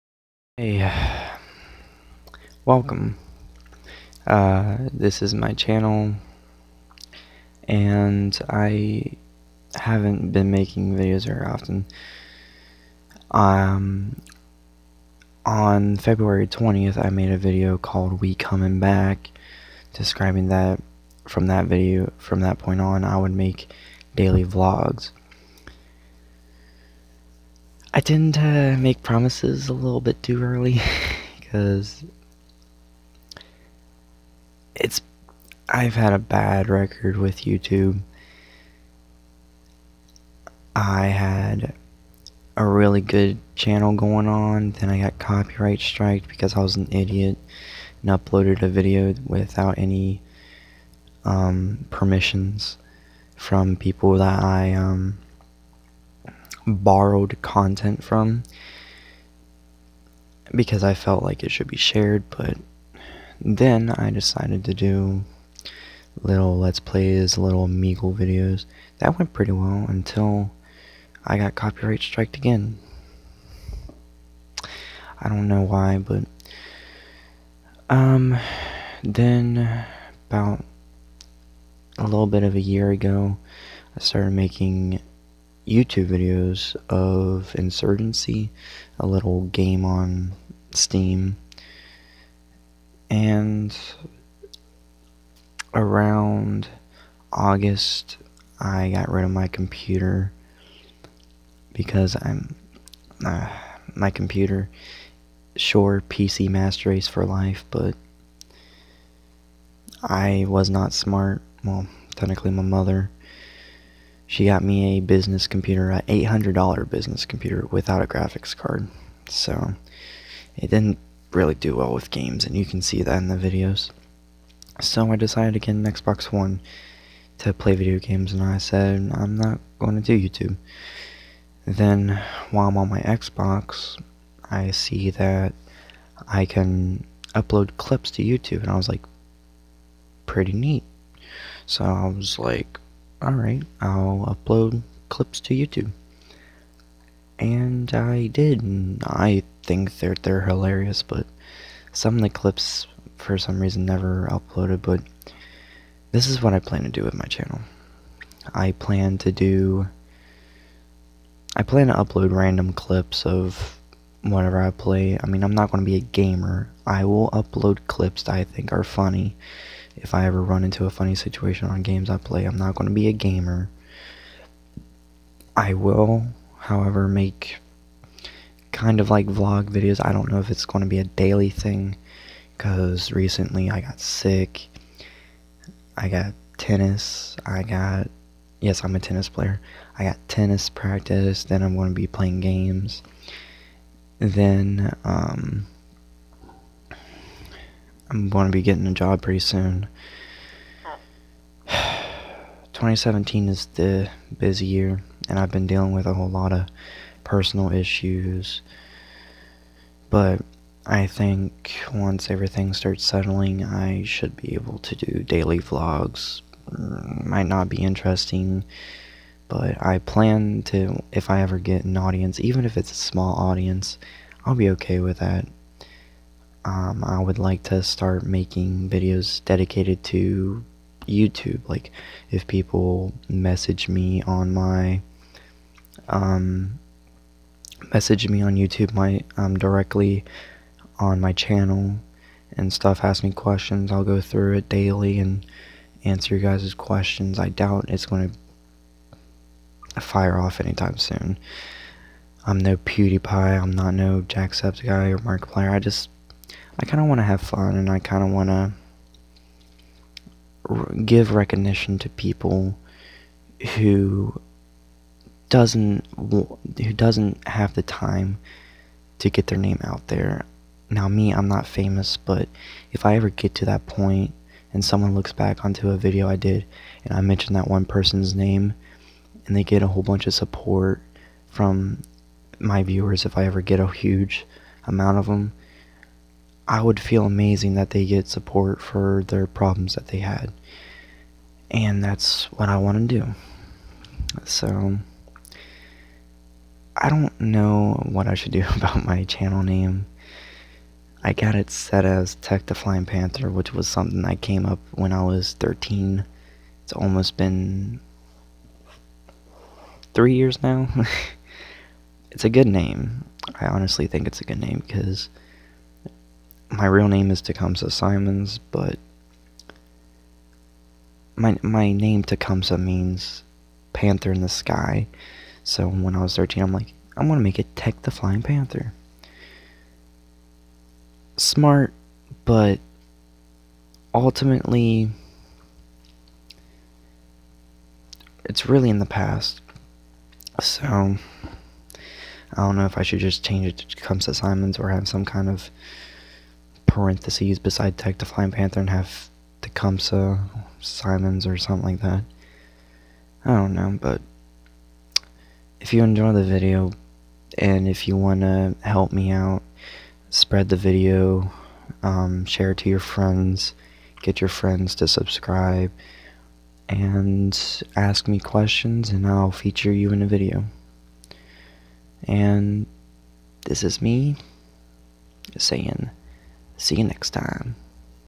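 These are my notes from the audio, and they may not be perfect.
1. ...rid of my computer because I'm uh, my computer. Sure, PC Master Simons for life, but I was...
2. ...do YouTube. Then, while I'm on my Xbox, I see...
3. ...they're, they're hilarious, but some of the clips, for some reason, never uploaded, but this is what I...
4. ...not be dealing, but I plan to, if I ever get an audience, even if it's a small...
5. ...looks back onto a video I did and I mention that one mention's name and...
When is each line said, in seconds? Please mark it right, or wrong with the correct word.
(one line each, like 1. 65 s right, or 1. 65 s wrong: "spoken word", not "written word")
1. 99 s wrong: "Race", not "Simons"
2. 130 s right
3. 149 s right
4. 217 s wrong: "interesting", not "dealing"
5. 275 s wrong: "person", not "mention".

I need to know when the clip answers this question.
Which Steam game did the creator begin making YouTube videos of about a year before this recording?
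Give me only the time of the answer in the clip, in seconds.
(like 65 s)
87 s.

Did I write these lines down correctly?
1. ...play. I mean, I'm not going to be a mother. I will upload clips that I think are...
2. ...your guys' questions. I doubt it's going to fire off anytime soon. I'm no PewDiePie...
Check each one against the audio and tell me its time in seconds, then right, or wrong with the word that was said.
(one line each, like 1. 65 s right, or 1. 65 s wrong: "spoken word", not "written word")
1. 164 s wrong: "gamer", not "mother"
2. 246 s right.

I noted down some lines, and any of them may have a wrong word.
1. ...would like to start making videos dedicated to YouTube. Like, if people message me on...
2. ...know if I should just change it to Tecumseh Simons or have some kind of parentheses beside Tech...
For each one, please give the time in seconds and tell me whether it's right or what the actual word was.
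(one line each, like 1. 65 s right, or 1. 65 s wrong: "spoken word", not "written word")
1. 227 s right
2. 342 s right.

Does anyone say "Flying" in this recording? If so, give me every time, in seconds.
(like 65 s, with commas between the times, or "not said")
302 s, 328 s, 348 s.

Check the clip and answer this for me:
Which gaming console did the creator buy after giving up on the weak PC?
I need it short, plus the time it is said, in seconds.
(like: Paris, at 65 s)
Xbox One, at 125 s.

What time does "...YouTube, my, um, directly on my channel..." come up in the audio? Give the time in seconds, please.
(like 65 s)
238 s.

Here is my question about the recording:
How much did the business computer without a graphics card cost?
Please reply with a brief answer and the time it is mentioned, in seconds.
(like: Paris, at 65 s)
$800, at 116 s.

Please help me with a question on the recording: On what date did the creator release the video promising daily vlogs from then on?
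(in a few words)
February 20th.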